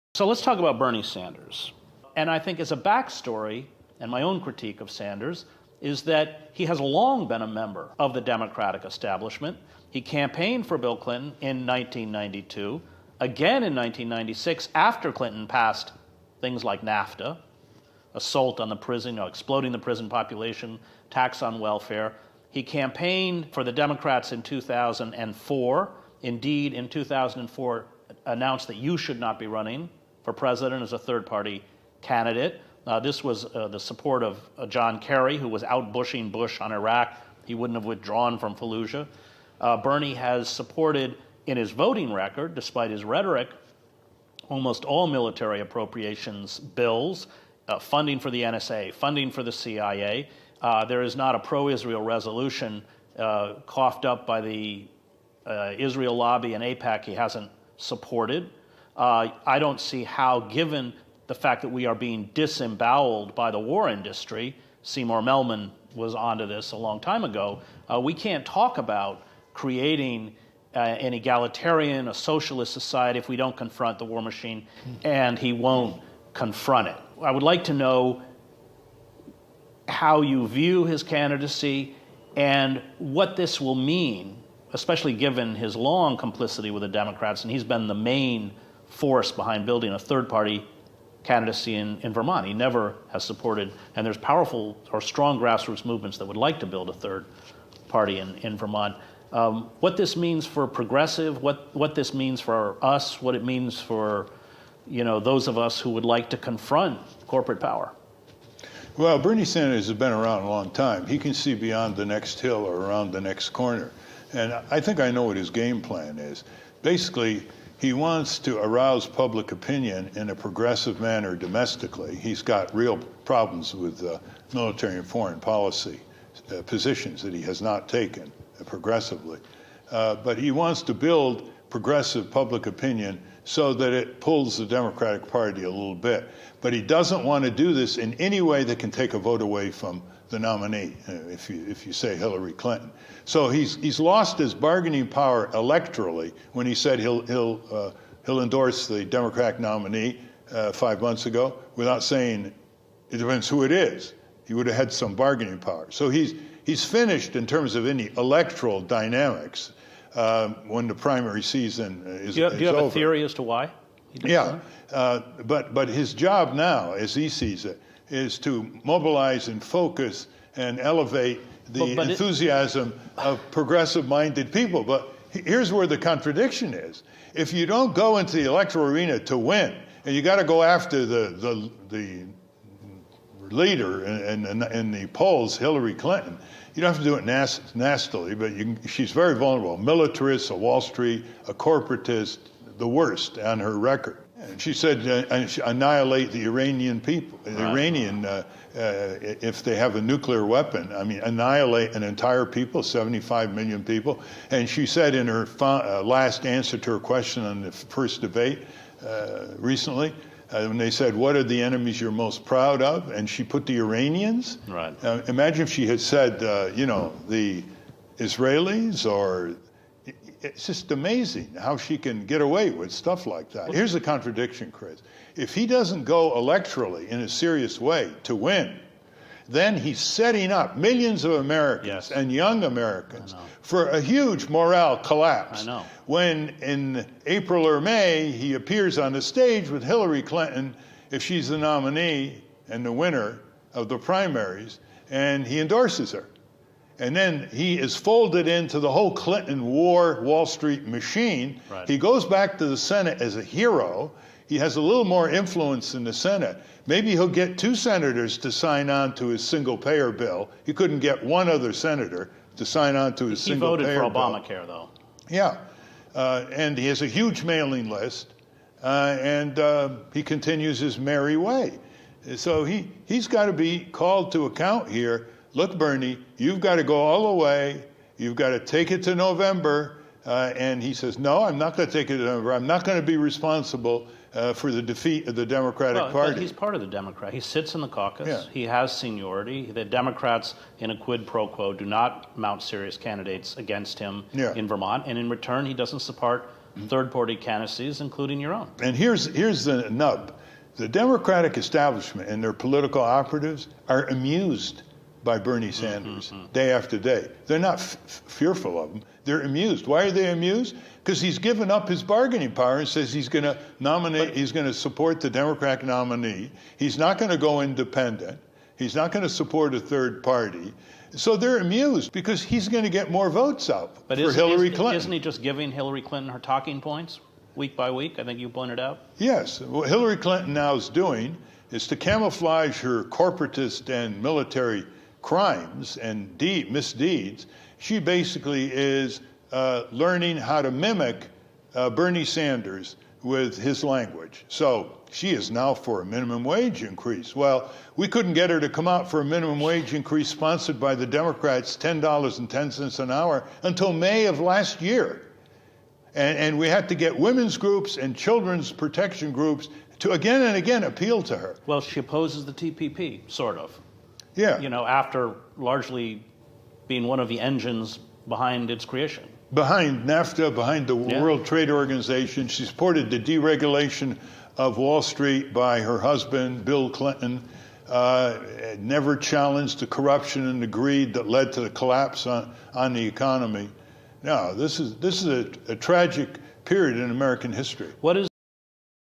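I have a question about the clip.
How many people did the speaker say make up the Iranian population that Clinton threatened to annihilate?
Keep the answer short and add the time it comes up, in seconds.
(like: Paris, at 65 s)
75 million, at 202 s.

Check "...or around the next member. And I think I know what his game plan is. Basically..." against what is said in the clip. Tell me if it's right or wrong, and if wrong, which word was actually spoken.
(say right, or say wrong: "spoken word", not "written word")
wrong: "corner", not "member".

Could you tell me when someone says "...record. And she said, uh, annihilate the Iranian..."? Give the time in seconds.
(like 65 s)
193 s.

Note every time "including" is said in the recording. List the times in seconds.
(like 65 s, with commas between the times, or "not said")
297 s.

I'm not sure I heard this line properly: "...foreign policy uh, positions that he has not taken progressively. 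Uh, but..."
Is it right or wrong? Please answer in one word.
right.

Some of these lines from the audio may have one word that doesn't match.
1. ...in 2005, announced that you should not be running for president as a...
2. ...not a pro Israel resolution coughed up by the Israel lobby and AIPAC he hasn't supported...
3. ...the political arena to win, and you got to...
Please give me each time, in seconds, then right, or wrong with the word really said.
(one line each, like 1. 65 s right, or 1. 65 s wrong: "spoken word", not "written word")
1. 26 s wrong: "2004", not "2005"
2. 51 s right
3. 178 s wrong: "electoral", not "political".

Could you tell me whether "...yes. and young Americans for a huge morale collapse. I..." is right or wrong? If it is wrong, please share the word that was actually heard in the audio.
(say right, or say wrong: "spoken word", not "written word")
right.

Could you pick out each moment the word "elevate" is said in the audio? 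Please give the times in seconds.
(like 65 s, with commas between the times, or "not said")
170 s.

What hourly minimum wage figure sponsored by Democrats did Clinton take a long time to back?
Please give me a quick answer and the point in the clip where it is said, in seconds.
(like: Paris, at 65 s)
$10.10, at 351 s.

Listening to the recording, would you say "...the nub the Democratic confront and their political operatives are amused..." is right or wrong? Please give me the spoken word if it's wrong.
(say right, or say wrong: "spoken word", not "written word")
wrong: "establishment", not "confront".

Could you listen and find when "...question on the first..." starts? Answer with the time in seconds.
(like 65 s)
206 s.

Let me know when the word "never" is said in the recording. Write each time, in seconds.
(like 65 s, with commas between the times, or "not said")
92 s, 378 s.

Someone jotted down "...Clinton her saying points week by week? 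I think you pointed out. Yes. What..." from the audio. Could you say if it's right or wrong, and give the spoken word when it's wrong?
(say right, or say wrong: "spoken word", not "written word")
wrong: "talking", not "saying".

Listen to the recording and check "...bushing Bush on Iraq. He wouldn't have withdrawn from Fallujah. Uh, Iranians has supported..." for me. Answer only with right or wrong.
wrong.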